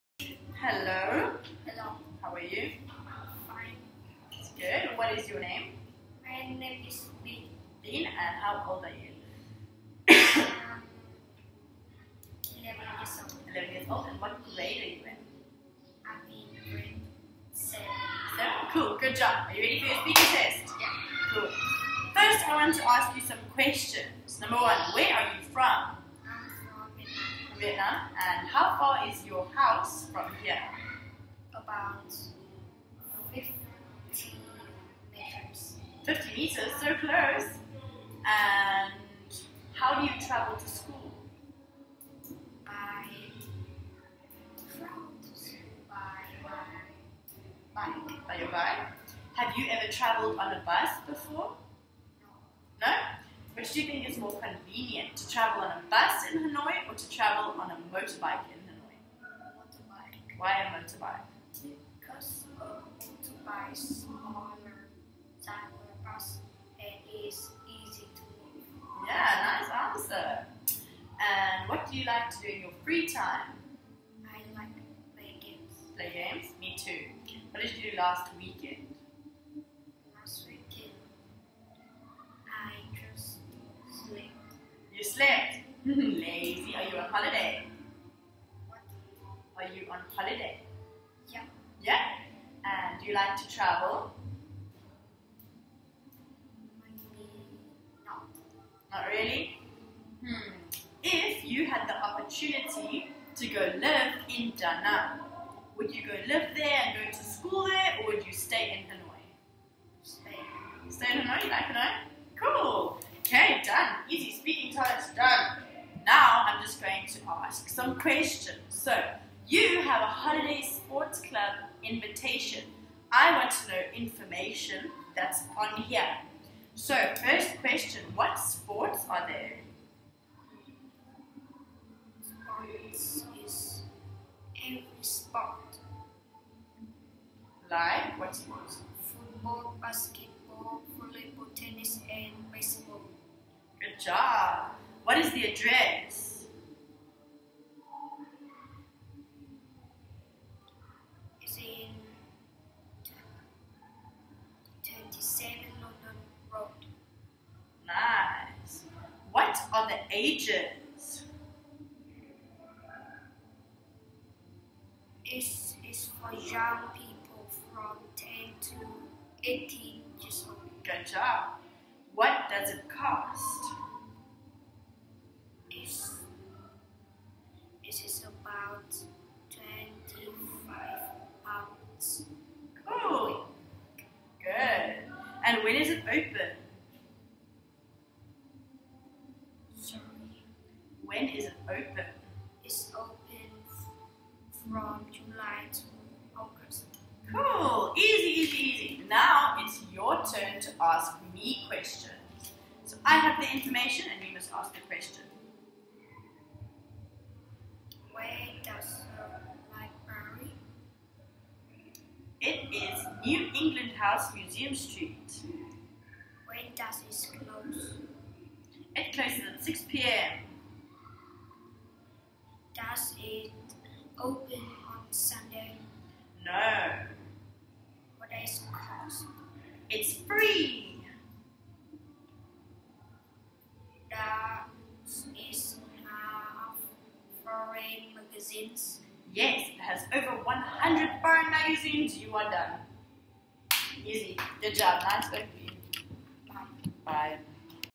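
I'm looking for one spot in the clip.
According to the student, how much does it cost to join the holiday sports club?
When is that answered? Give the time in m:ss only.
2:59.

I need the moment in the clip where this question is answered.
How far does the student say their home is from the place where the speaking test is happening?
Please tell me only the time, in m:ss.
0:31.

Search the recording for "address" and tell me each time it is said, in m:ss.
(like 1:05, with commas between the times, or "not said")
2:25.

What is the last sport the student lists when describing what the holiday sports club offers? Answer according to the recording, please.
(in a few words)
baseball.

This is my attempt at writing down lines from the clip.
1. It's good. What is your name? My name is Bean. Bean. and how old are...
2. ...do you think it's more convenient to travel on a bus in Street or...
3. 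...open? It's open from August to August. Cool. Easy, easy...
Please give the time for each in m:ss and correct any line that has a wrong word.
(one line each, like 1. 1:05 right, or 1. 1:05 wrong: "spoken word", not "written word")
1. 0:04 right
2. 0:53 wrong: "Hanoi", not "Street"
3. 3:11 wrong: "July", not "August".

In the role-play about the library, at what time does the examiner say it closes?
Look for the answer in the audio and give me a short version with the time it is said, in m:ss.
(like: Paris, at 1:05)
6 p.m., at 3:39.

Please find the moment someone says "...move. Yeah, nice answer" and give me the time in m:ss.
1:08.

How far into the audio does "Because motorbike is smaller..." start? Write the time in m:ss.
1:01.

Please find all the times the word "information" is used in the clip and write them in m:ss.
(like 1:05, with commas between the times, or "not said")
2:03, 3:23.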